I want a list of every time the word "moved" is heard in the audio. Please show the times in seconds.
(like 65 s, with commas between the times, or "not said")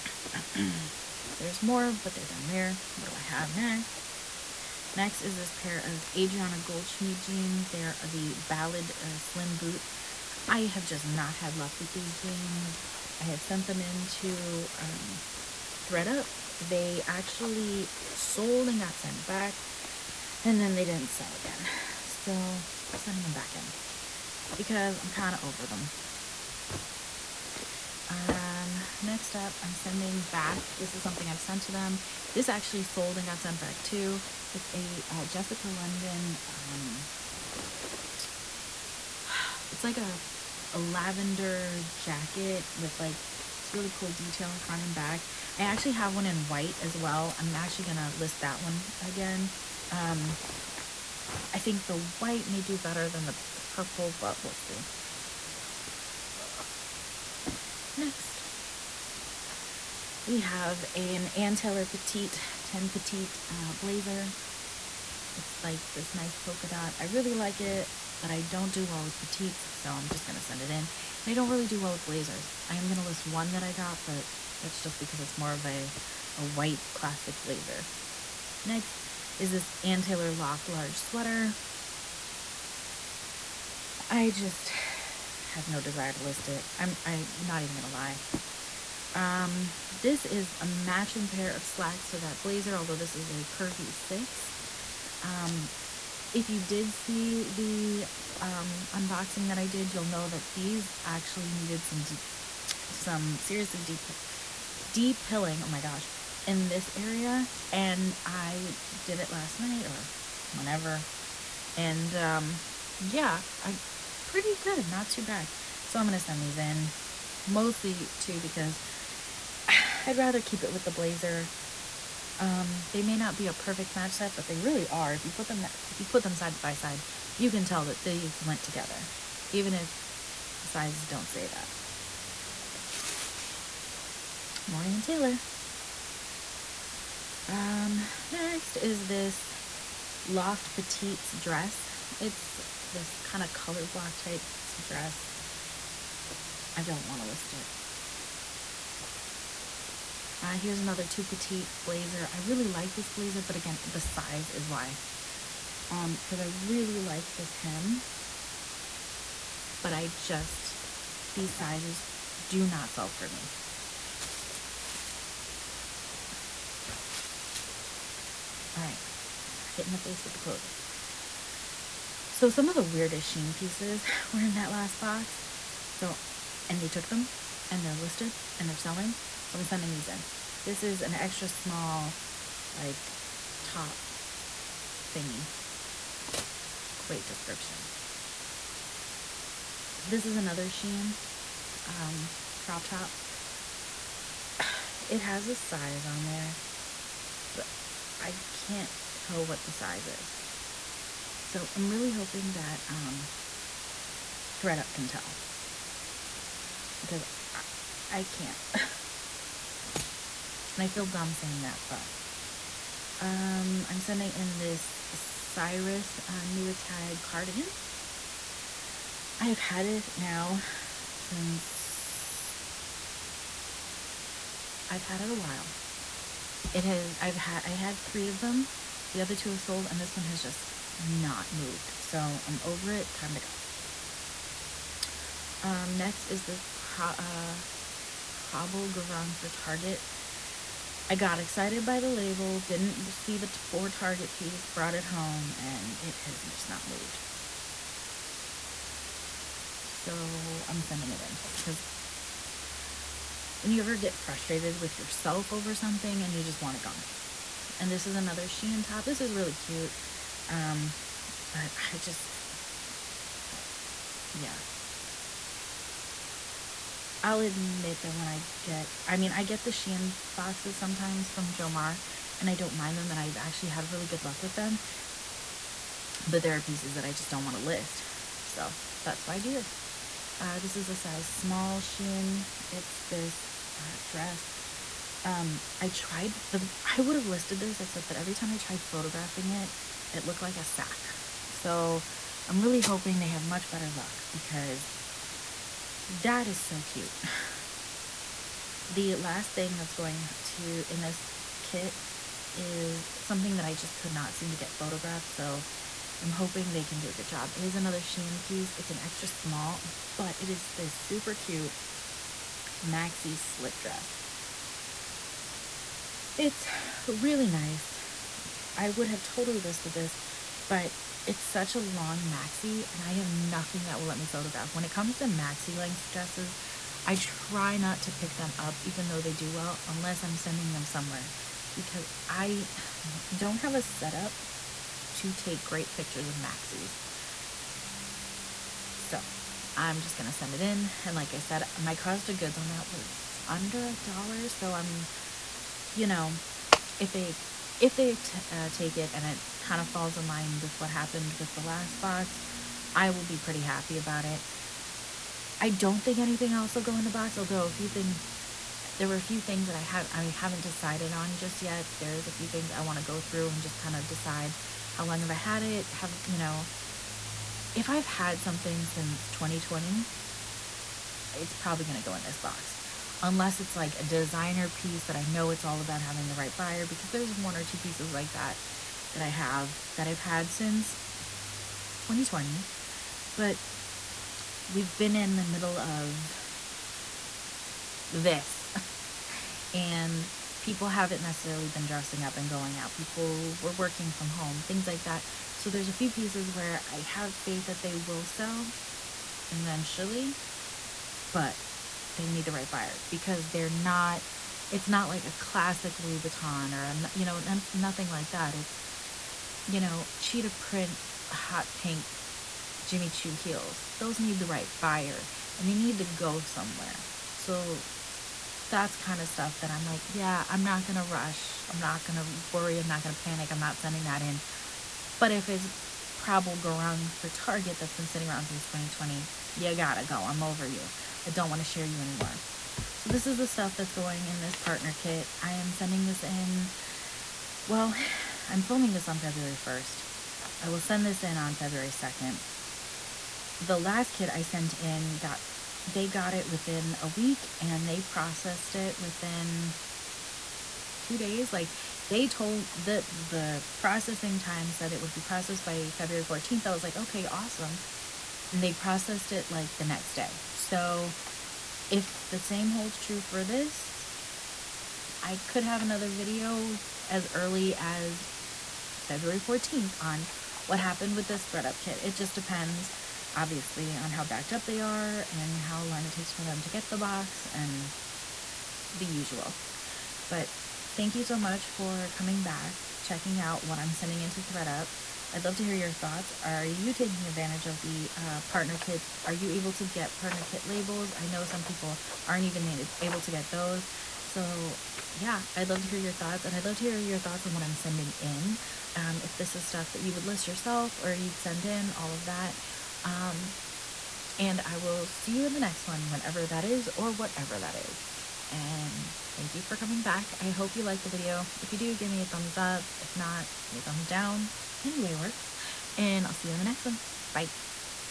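231 s, 246 s.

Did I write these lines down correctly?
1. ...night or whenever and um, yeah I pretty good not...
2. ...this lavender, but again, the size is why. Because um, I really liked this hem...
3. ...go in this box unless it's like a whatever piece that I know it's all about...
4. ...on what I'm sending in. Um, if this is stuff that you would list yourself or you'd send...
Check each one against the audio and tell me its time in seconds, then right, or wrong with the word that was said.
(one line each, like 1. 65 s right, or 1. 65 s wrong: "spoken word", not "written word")
1. 109 s right
2. 152 s wrong: "blazer", not "lavender"
3. 372 s wrong: "designer", not "whatever"
4. 497 s right.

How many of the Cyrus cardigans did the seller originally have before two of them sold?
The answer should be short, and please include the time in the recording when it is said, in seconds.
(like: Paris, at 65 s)
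3, at 228 s.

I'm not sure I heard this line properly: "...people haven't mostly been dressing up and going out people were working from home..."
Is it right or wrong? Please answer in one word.
wrong.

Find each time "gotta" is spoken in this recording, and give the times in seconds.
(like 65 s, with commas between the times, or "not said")
429 s.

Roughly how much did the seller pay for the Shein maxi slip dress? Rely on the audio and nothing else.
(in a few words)
under a dollar.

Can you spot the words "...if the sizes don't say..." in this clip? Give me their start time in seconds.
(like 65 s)
129 s.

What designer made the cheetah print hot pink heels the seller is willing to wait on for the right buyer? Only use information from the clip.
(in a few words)
Jimmy Choo.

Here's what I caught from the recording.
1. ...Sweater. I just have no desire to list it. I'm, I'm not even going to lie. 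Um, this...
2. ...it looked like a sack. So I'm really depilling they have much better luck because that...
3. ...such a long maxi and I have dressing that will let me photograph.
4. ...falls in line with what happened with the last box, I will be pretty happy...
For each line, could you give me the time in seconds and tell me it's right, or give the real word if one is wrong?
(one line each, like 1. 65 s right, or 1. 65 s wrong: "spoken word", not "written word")
1. 80 s right
2. 290 s wrong: "hoping", not "depilling"
3. 321 s wrong: "nothing", not "dressing"
4. 349 s right.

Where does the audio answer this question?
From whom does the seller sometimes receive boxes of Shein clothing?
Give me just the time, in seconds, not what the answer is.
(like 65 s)
271 s.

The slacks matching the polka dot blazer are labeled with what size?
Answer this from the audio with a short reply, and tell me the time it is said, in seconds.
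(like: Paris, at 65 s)
curvy 6, at 93 s.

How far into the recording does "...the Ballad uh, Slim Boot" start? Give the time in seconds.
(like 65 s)
8 s.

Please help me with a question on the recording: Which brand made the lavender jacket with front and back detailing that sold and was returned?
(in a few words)
Jessica London.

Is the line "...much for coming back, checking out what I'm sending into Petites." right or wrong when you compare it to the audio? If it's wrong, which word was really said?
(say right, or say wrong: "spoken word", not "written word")
wrong: "ThredUP", not "Petites".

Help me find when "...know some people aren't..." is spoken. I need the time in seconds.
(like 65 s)
491 s.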